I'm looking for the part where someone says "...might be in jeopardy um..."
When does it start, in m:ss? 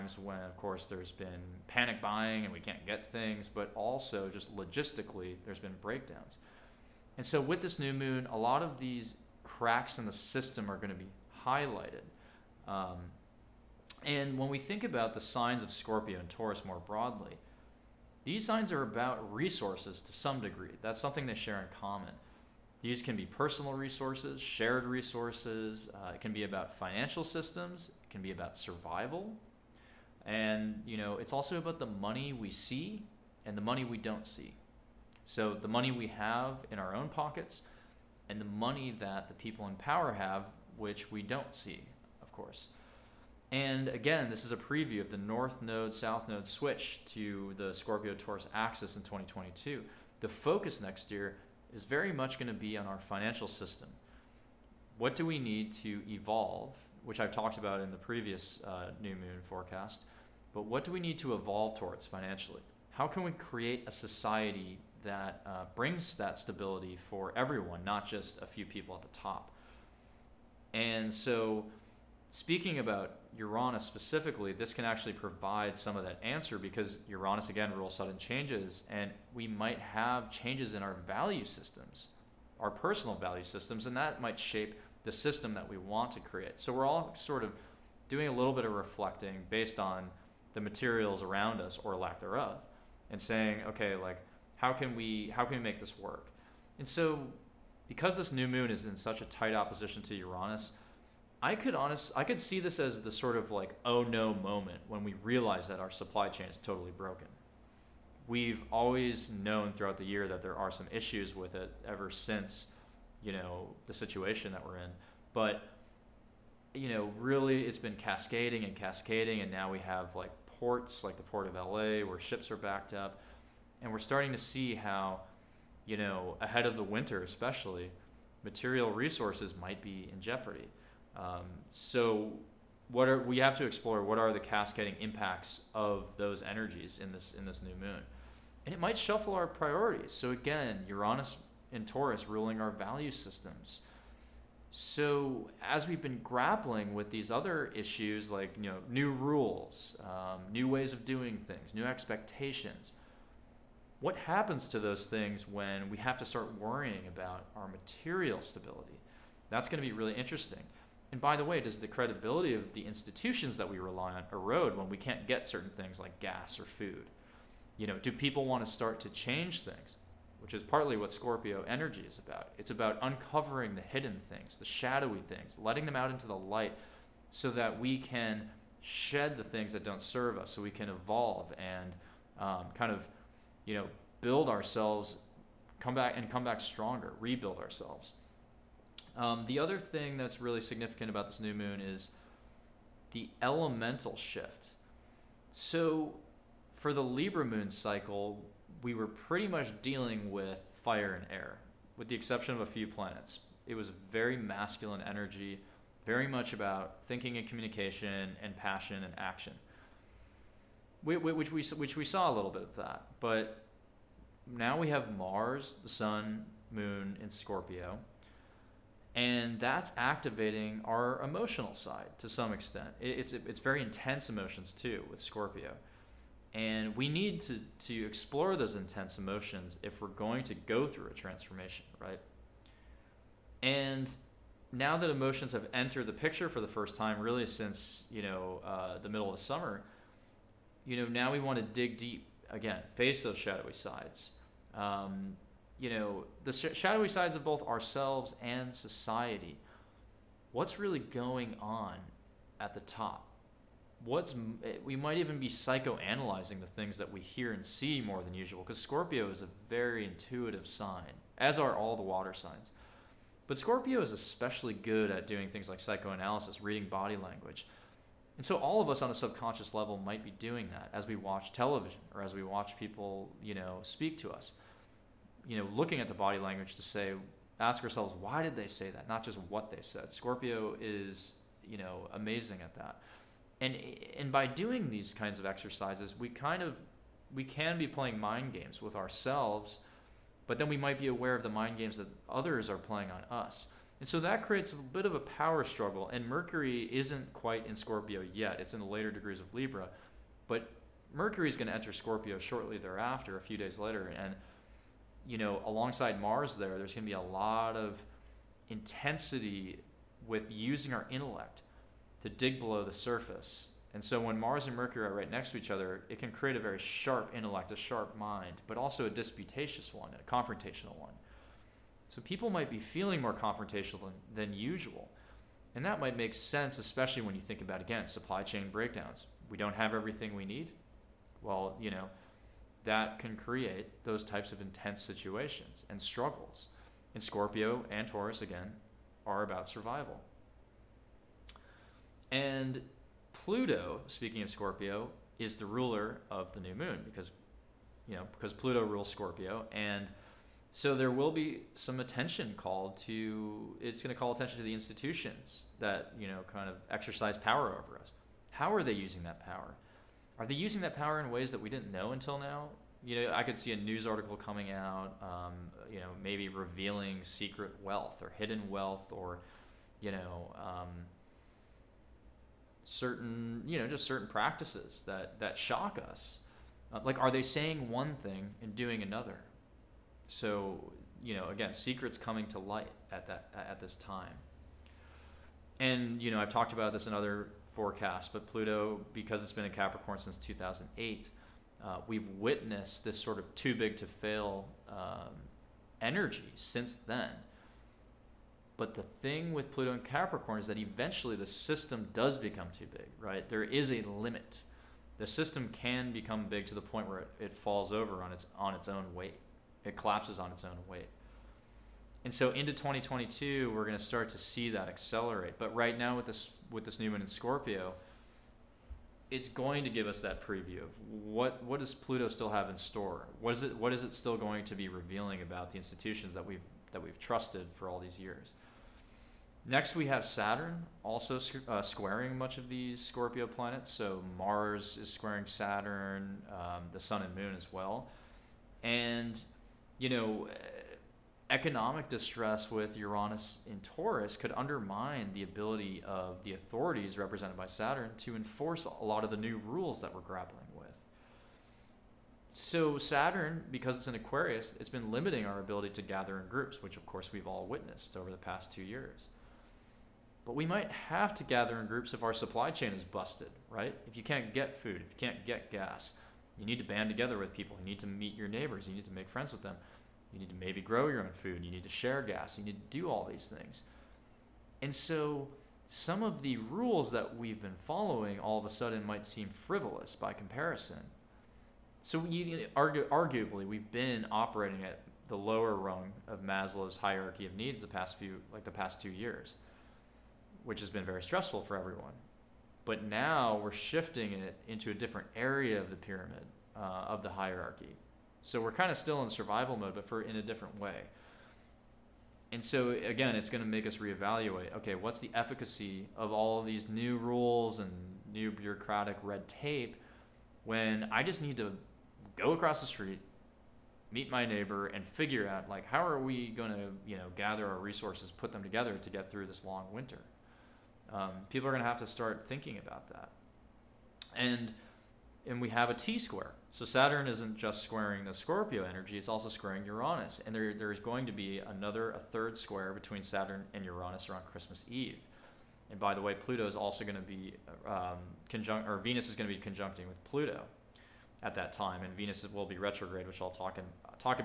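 2:09.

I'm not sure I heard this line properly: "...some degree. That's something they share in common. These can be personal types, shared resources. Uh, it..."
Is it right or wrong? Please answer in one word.
wrong.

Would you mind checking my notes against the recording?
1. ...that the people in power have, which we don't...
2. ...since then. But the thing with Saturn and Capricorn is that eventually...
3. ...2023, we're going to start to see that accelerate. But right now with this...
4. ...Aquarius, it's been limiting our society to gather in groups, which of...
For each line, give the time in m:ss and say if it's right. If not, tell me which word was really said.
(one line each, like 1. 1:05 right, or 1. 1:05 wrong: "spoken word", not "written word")
1. 0:39 right
2. 6:36 wrong: "Pluto", not "Saturn"
3. 6:52 wrong: "2022", not "2023"
4. 7:34 wrong: "ability", not "society".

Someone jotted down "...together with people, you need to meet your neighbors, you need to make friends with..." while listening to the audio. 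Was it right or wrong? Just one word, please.
right.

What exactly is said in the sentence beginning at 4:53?
And so that creates a bit of a power struggle.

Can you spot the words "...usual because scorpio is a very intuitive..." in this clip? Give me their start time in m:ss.
4:18.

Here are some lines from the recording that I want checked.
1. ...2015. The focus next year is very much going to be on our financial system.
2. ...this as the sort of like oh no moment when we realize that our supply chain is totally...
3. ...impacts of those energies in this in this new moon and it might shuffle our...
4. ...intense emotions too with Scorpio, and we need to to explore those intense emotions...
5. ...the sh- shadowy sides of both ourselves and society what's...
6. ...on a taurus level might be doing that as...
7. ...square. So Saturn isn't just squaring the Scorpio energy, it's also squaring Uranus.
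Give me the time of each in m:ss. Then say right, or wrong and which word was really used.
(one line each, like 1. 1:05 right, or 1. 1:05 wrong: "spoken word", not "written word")
1. 0:49 wrong: "2022", not "2015"
2. 1:42 right
3. 2:15 right
4. 3:43 right
5. 4:06 right
6. 4:29 wrong: "subconscious", not "taurus"
7. 8:46 right.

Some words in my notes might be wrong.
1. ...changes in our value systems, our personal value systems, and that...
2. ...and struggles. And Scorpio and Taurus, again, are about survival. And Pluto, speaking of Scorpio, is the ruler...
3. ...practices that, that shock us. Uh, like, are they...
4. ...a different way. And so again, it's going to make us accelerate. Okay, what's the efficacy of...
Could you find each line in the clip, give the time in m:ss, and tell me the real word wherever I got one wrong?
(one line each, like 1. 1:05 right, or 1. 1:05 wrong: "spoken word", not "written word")
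1. 1:20 right
2. 5:35 right
3. 6:14 right
4. 8:20 wrong: "reevaluate", not "accelerate".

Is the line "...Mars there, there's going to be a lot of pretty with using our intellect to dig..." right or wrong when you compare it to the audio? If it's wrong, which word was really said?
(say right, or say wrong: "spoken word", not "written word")
wrong: "intensity", not "pretty".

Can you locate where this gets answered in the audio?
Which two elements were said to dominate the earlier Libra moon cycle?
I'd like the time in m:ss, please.
3:20.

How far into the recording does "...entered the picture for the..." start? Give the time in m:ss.
3:55.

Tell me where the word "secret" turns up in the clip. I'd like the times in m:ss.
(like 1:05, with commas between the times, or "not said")
6:07, 6:21.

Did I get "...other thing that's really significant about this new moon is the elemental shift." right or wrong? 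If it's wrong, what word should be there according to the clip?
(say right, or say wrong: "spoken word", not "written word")
right.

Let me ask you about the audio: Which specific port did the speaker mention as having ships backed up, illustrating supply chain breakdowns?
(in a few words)
Port of LA.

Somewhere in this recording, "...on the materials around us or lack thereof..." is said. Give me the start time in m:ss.
1:29.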